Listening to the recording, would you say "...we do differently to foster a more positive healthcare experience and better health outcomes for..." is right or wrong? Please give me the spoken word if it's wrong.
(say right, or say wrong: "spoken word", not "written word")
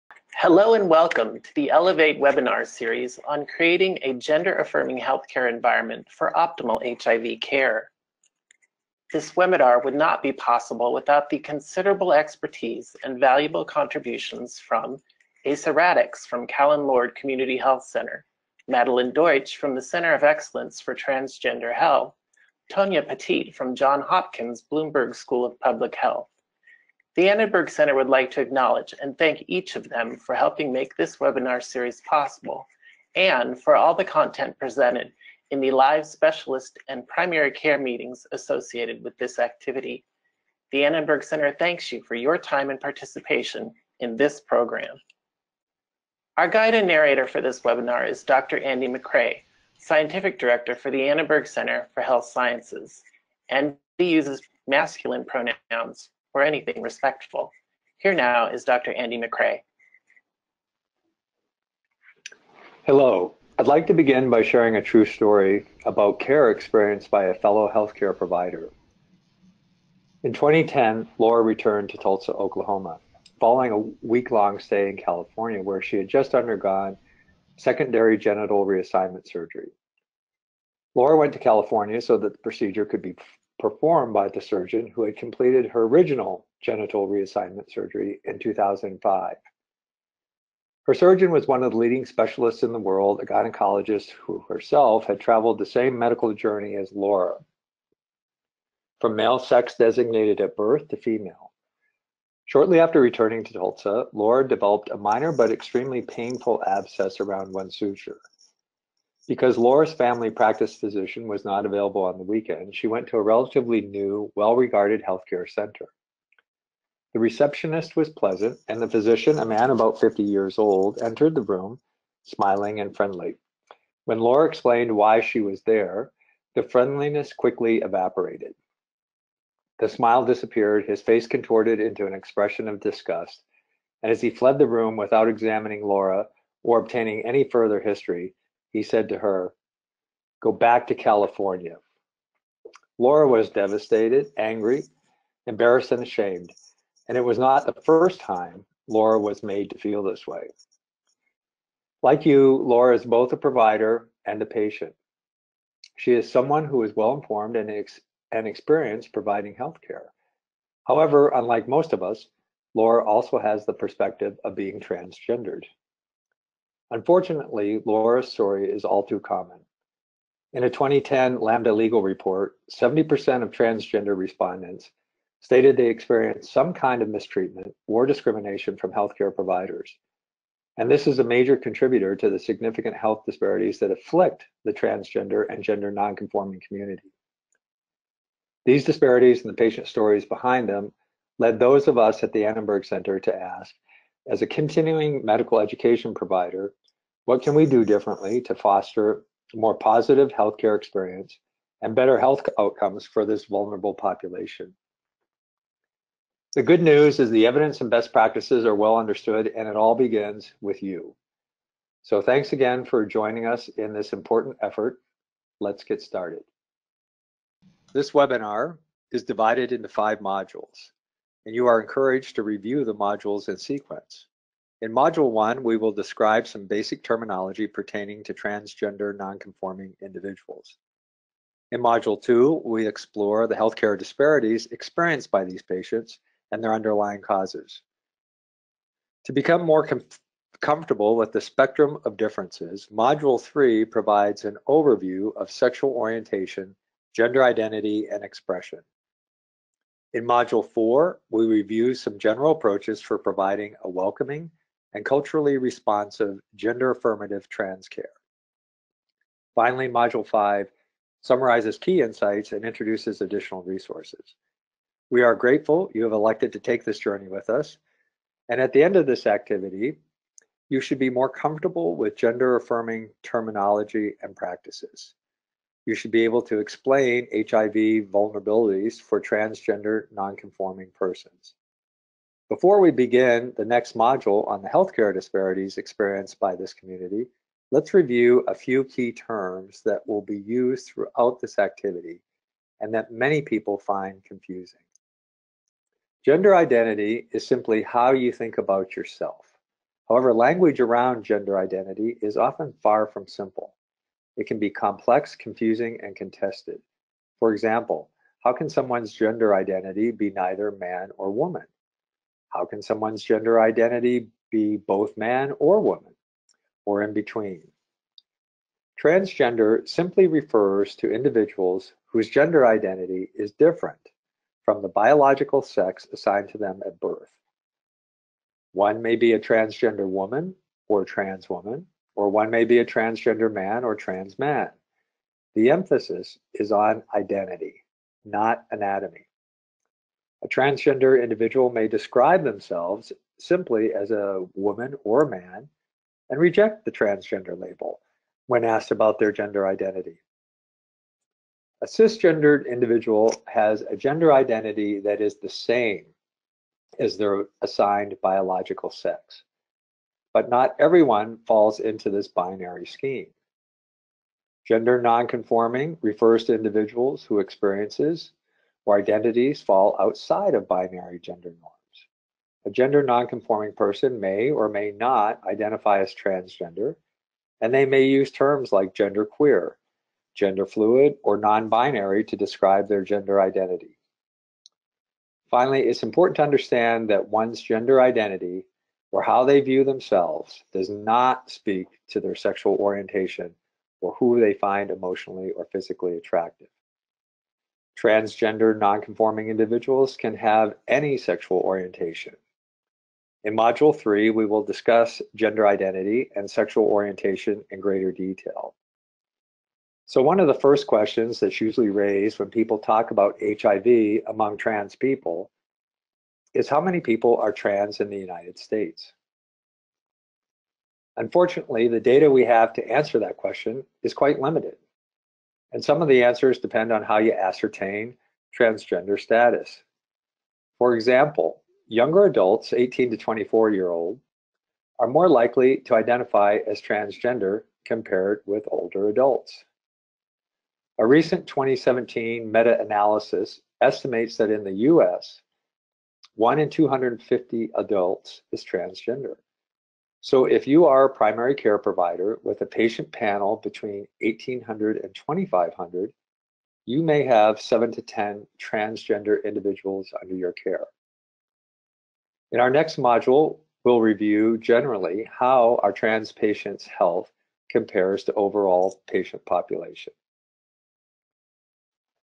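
right.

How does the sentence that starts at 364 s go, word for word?
Gender nonconforming refers to individuals who experiences where identities fall outside of binary gender norms.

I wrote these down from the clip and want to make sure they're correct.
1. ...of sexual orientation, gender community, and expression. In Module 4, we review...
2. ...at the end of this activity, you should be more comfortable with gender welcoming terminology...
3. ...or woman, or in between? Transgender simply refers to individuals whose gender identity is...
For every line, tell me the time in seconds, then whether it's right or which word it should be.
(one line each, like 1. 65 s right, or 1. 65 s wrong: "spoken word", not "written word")
1. 245 s wrong: "identity", not "community"
2. 268 s wrong: "affirming", not "welcoming"
3. 315 s right.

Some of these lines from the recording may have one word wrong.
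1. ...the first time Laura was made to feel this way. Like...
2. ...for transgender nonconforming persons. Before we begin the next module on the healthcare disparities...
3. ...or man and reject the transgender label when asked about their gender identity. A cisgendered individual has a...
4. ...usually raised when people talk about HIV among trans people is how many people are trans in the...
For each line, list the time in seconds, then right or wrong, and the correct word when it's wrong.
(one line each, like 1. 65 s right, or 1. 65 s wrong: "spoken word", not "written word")
1. 147 s right
2. 279 s right
3. 345 s right
4. 411 s right.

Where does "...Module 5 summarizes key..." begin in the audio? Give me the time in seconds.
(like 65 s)
259 s.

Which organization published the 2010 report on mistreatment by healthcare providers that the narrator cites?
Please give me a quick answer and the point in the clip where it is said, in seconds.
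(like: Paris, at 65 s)
Lambda Legal, at 171 s.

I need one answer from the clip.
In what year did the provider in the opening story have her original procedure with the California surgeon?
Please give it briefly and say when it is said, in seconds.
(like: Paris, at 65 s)
2005, at 88 s.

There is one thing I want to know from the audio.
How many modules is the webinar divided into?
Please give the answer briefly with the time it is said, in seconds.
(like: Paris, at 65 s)
5, at 219 s.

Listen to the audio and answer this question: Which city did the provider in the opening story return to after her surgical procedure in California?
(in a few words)
Tulsa, Oklahoma.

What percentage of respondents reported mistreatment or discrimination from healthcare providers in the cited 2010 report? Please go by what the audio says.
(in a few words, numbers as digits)
70%.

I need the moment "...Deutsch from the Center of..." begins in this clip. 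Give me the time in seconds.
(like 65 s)
19 s.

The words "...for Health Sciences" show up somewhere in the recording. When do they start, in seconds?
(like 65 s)
51 s.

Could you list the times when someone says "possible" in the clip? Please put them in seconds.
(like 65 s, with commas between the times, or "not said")
10 s, 32 s.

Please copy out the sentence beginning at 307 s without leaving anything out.
For example, how can someone's gender identity be neither man or woman?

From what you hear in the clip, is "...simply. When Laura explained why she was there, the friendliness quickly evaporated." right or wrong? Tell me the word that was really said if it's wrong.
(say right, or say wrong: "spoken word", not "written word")
wrong: "friendly", not "simply".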